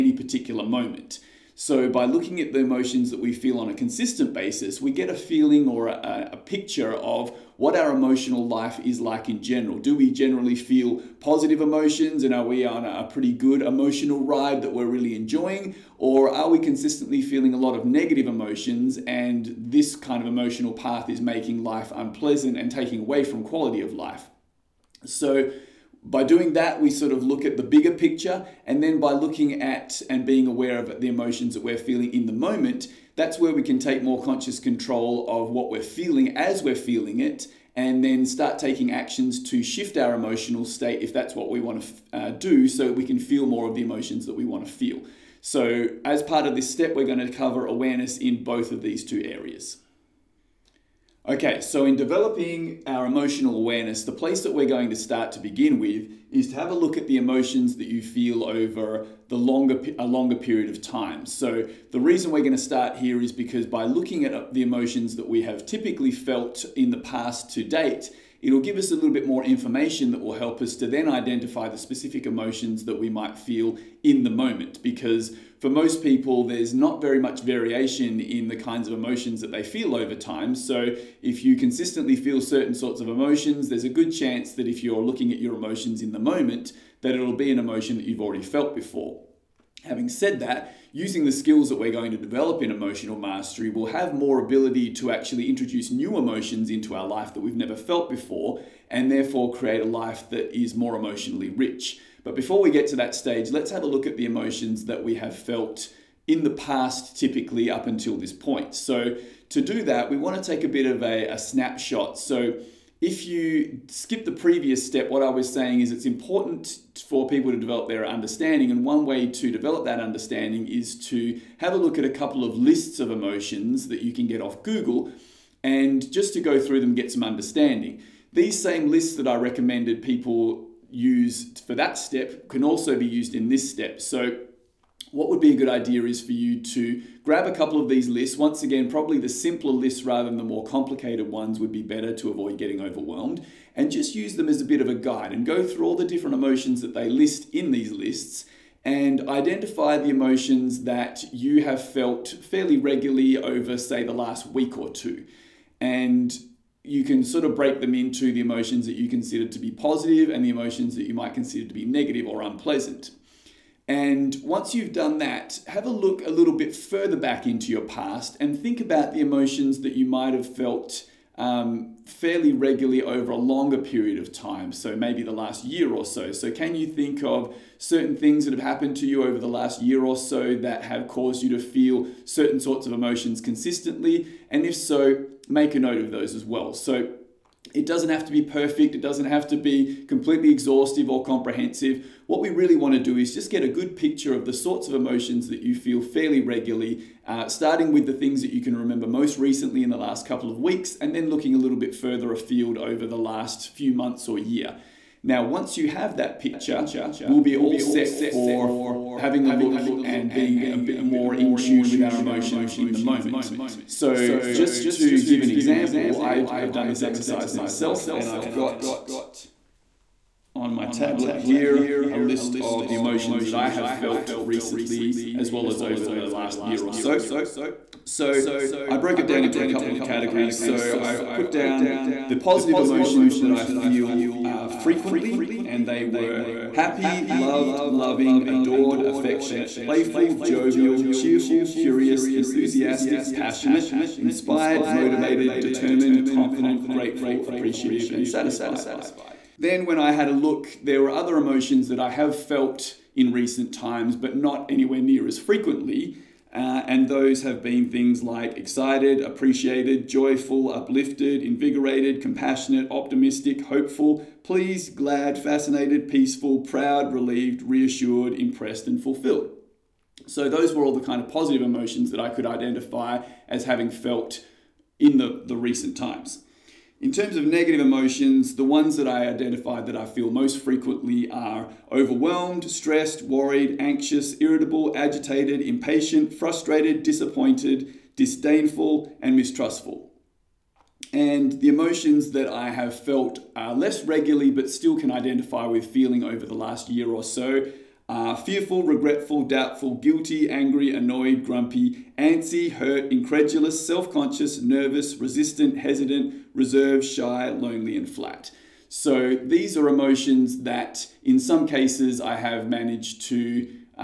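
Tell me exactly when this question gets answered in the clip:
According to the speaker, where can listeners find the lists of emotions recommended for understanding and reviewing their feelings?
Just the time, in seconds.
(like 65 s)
124 s.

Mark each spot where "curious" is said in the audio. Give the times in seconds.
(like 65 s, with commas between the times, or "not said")
241 s.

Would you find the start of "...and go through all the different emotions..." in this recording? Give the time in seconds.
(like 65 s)
145 s.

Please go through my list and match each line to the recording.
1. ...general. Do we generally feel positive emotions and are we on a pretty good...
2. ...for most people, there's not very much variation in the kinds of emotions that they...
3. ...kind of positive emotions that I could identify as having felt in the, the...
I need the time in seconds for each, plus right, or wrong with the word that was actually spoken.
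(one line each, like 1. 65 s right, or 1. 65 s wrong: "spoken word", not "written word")
1. 9 s right
2. 75 s right
3. 271 s right.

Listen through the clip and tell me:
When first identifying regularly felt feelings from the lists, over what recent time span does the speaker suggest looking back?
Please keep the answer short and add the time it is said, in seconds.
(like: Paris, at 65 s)
the last week or two, at 154 s.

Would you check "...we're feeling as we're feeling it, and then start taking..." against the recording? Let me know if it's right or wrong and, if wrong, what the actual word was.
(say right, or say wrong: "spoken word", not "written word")
right.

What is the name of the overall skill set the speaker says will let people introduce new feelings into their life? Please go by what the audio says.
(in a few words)
emotional mastery.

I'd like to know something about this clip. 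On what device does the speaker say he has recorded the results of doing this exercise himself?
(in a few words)
tablet.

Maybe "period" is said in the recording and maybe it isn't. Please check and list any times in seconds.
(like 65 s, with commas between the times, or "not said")
60 s, 173 s.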